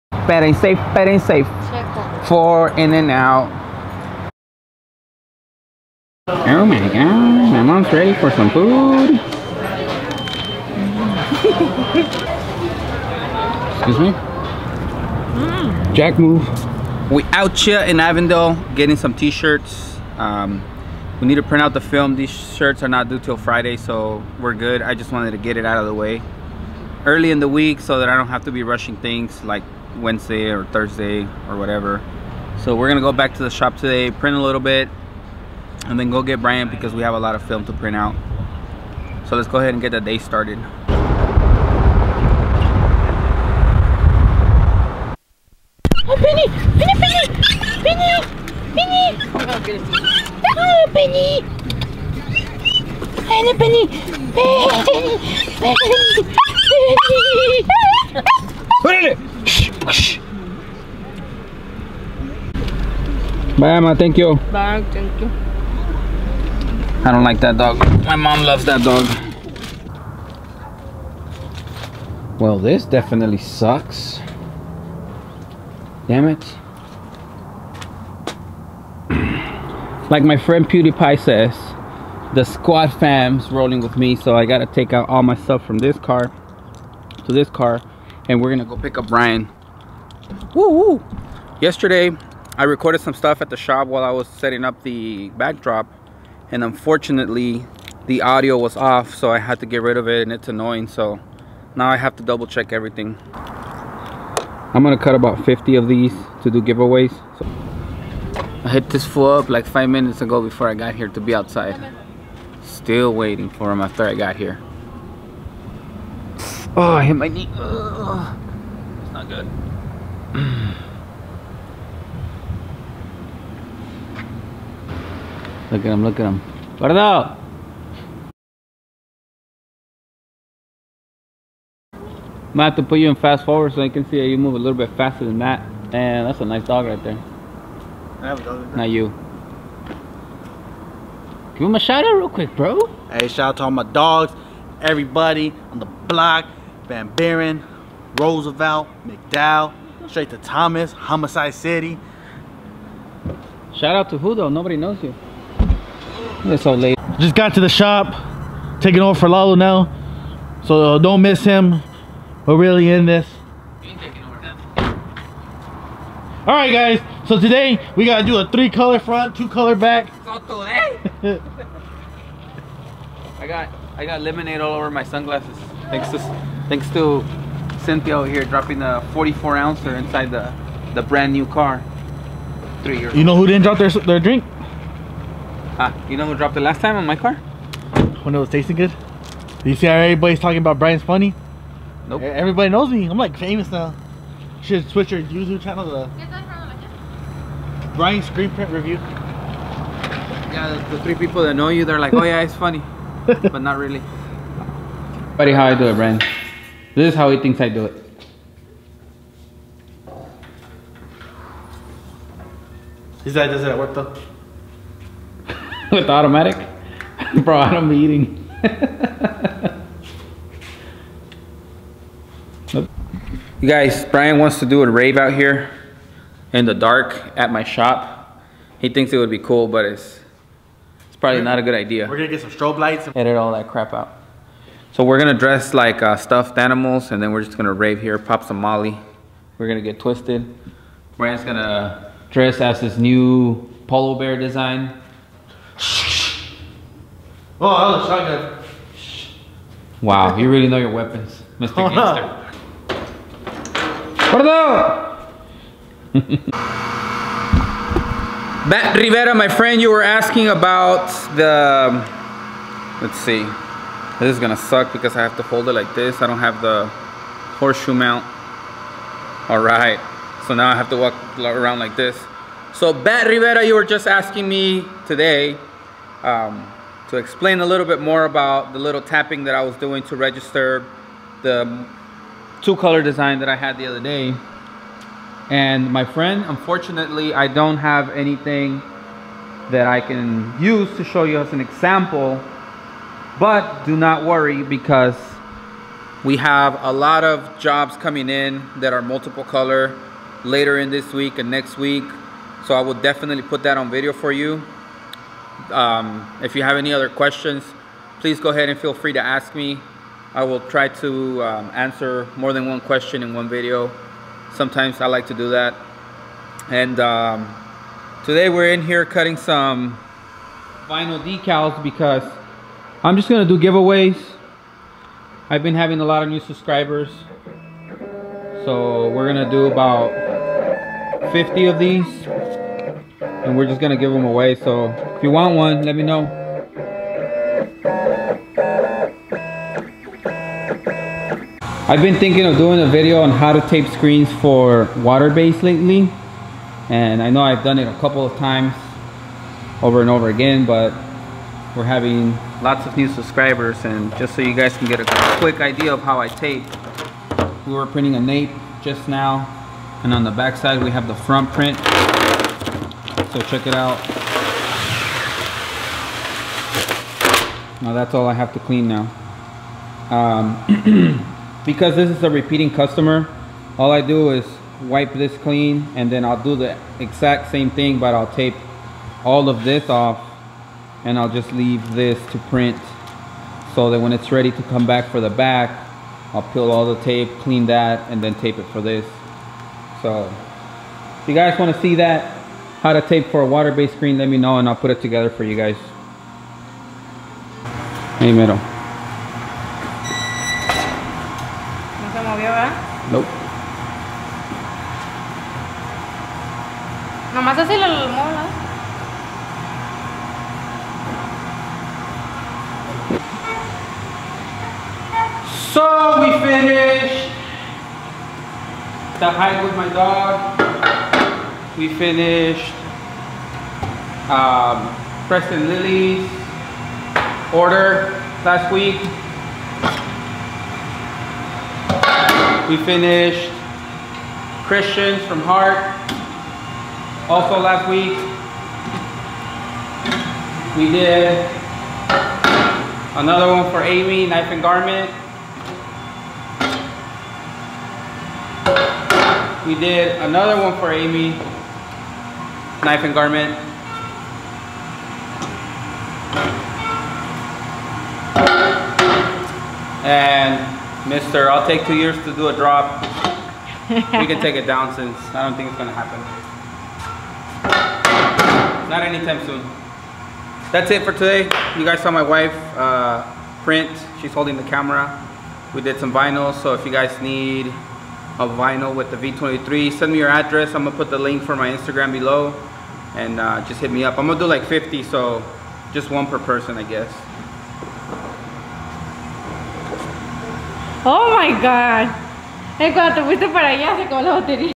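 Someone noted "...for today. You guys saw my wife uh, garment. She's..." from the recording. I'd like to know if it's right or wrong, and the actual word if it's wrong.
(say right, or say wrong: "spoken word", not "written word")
wrong: "print", not "garment".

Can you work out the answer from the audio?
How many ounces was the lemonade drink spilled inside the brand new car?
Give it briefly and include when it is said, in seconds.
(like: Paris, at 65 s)
44, at 179 s.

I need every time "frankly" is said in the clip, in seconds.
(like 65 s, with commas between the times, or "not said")
not said.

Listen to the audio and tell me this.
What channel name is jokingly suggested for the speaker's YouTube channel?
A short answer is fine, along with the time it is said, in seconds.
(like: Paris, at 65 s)
Brian's Screen Print Review, at 197 s.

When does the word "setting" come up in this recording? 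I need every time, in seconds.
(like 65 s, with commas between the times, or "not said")
94 s.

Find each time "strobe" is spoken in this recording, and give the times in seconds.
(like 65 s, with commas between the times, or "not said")
232 s.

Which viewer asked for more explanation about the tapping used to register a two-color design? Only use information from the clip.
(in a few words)
Matt Rivera.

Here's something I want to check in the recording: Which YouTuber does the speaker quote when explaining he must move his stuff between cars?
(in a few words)
PewDiePie.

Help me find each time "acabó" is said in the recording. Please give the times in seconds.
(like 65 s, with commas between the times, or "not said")
494 s.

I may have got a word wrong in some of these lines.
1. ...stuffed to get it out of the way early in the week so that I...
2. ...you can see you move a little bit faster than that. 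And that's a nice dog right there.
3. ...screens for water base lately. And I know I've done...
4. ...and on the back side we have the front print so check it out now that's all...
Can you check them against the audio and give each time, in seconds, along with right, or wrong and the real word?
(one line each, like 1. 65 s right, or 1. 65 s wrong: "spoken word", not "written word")
1. 25 s wrong: "wanted", not "stuffed"
2. 133 s right
3. 343 s right
4. 360 s right.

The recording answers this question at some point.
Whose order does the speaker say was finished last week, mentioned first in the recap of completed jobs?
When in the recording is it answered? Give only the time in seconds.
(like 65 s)
425 s.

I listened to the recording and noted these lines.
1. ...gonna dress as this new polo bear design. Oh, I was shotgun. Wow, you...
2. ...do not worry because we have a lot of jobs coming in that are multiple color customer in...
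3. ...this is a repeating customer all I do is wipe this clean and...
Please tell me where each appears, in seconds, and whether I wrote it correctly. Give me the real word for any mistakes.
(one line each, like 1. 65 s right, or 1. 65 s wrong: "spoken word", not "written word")
1. 241 s right
2. 293 s wrong: "later", not "customer"
3. 371 s right.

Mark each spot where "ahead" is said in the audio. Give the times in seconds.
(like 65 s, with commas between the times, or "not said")
39 s, 308 s.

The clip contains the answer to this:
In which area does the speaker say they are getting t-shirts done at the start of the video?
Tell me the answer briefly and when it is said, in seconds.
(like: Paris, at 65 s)
Avondale, at 17 s.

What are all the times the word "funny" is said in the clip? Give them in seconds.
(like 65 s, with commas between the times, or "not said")
191 s, 202 s.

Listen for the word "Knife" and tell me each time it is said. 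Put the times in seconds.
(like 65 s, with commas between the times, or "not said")
444 s, 452 s.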